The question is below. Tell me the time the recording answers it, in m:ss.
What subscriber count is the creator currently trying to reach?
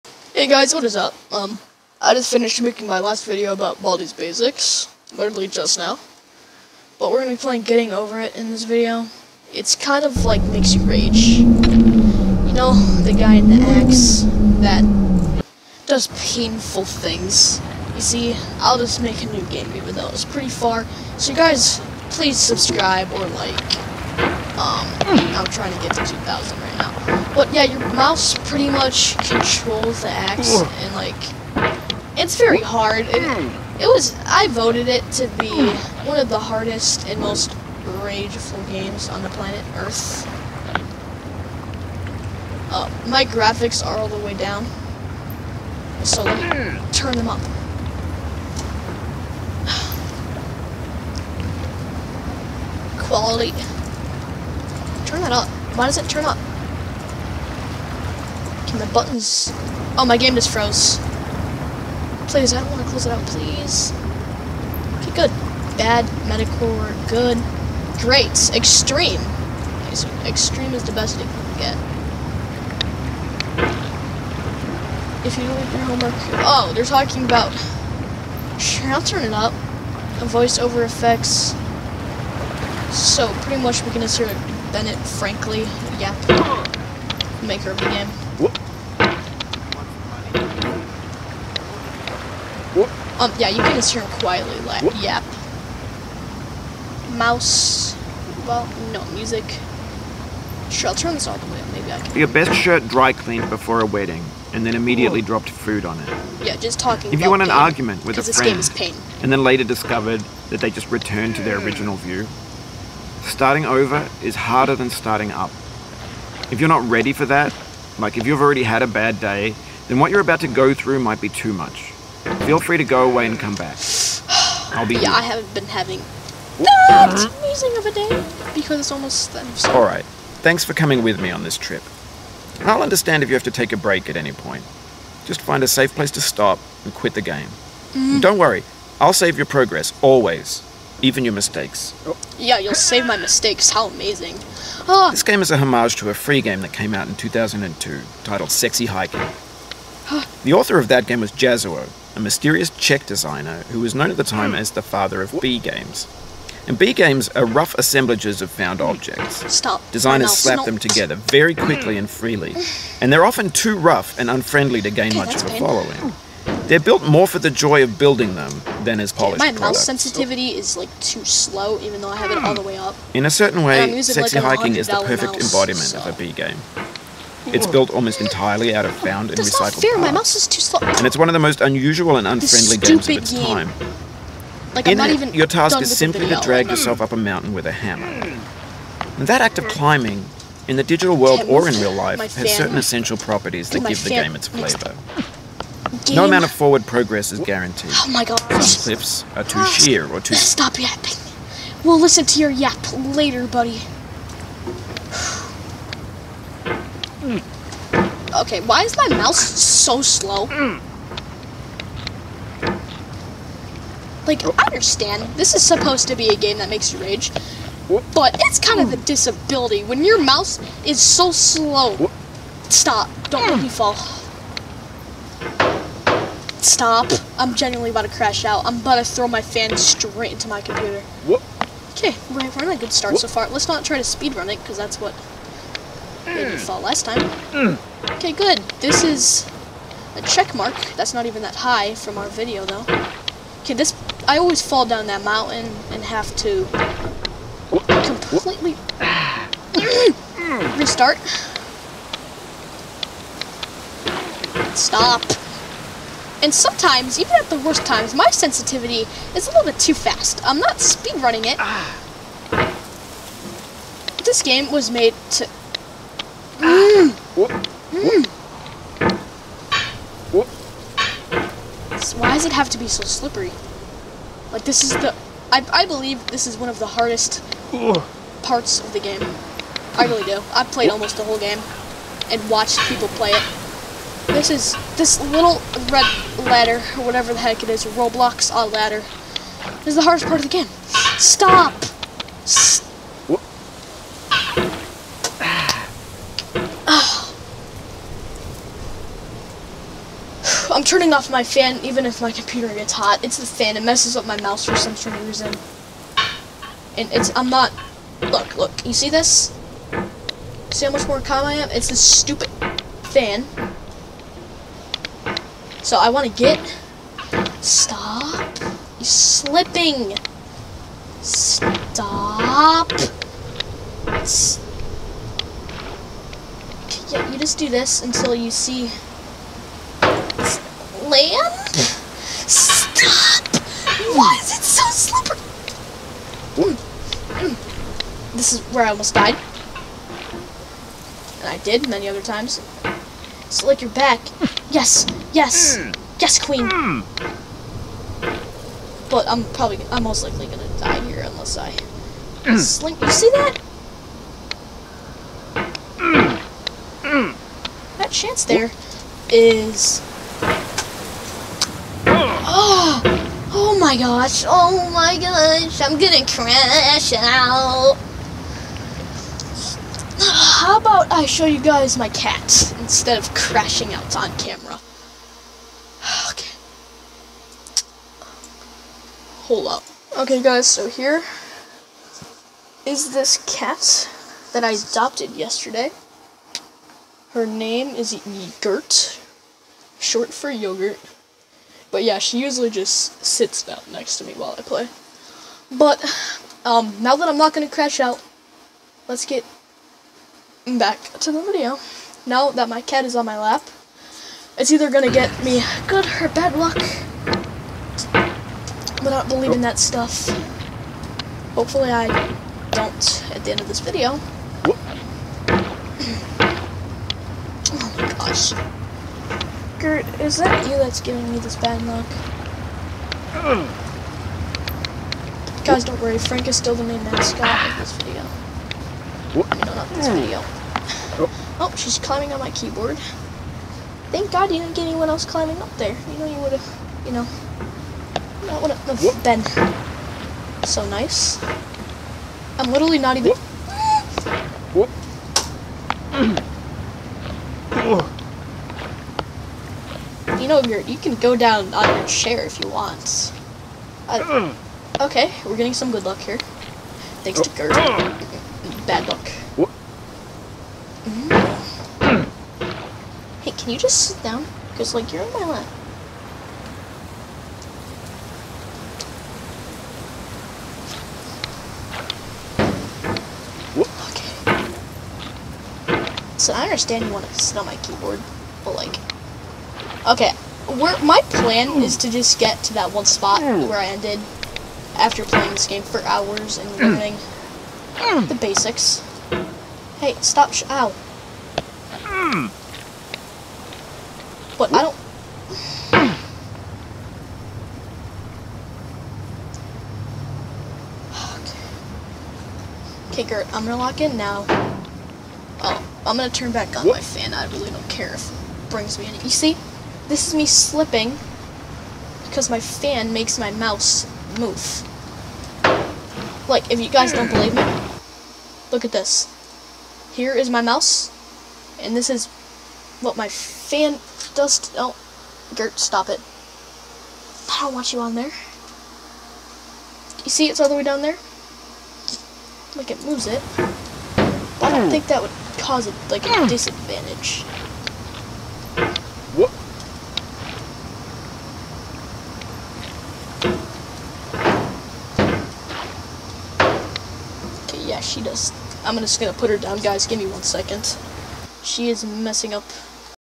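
0:26.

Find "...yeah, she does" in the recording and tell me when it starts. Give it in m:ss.
9:07.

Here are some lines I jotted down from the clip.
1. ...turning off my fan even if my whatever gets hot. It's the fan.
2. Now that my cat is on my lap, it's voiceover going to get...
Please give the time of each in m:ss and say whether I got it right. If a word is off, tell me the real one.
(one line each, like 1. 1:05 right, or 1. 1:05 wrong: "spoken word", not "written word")
1. 5:00 wrong: "computer", not "whatever"
2. 6:42 wrong: "either", not "voiceover".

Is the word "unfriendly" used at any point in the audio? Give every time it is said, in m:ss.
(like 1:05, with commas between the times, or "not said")
2:44, 3:02.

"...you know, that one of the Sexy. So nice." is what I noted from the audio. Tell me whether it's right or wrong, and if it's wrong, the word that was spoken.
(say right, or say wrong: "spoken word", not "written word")
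wrong: "Ben", not "Sexy".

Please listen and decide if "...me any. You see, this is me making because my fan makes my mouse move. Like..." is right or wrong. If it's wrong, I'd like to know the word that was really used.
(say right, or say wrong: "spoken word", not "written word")
wrong: "slipping", not "making".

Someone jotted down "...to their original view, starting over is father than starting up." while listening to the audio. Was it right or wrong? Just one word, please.
wrong.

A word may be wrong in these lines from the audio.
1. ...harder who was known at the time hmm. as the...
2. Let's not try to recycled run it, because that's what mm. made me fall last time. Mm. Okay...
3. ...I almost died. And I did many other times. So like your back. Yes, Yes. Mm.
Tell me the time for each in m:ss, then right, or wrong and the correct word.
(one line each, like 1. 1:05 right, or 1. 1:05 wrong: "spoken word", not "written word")
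1. 2:33 wrong: "designer", not "harder"
2. 3:53 wrong: "speed", not "recycled"
3. 5:38 right.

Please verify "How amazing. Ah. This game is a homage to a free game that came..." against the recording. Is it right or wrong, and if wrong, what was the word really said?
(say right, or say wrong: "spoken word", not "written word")
right.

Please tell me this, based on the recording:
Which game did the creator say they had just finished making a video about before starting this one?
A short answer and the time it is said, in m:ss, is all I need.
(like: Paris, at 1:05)
Baldi's Basics, at 0:03.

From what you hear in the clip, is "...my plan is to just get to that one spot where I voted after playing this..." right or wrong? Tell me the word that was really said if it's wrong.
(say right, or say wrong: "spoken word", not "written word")
wrong: "ended", not "voted".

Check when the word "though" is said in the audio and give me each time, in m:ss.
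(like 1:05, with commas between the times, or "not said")
0:19, 2:51, 4:02.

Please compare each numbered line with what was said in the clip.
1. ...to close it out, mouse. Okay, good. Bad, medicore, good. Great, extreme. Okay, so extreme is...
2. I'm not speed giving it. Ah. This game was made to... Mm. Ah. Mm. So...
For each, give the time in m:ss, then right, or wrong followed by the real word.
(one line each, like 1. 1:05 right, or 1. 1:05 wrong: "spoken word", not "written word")
1. 1:02 wrong: "please", not "mouse"
2. 4:20 wrong: "running", not "giving".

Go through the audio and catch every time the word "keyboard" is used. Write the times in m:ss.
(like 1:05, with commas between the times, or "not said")
7:12, 7:57.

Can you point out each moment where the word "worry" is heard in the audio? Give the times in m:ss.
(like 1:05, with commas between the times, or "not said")
2:18, 7:06.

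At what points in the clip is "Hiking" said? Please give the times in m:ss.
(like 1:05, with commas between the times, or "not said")
2:28, 2:54.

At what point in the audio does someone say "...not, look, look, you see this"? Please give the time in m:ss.
5:07.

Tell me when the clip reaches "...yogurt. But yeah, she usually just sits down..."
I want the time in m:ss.
6:30.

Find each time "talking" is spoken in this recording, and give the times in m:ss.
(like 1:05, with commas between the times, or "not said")
1:16, 1:46.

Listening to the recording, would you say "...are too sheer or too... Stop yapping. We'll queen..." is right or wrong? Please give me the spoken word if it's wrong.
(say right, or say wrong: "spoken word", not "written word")
wrong: "listen", not "queen".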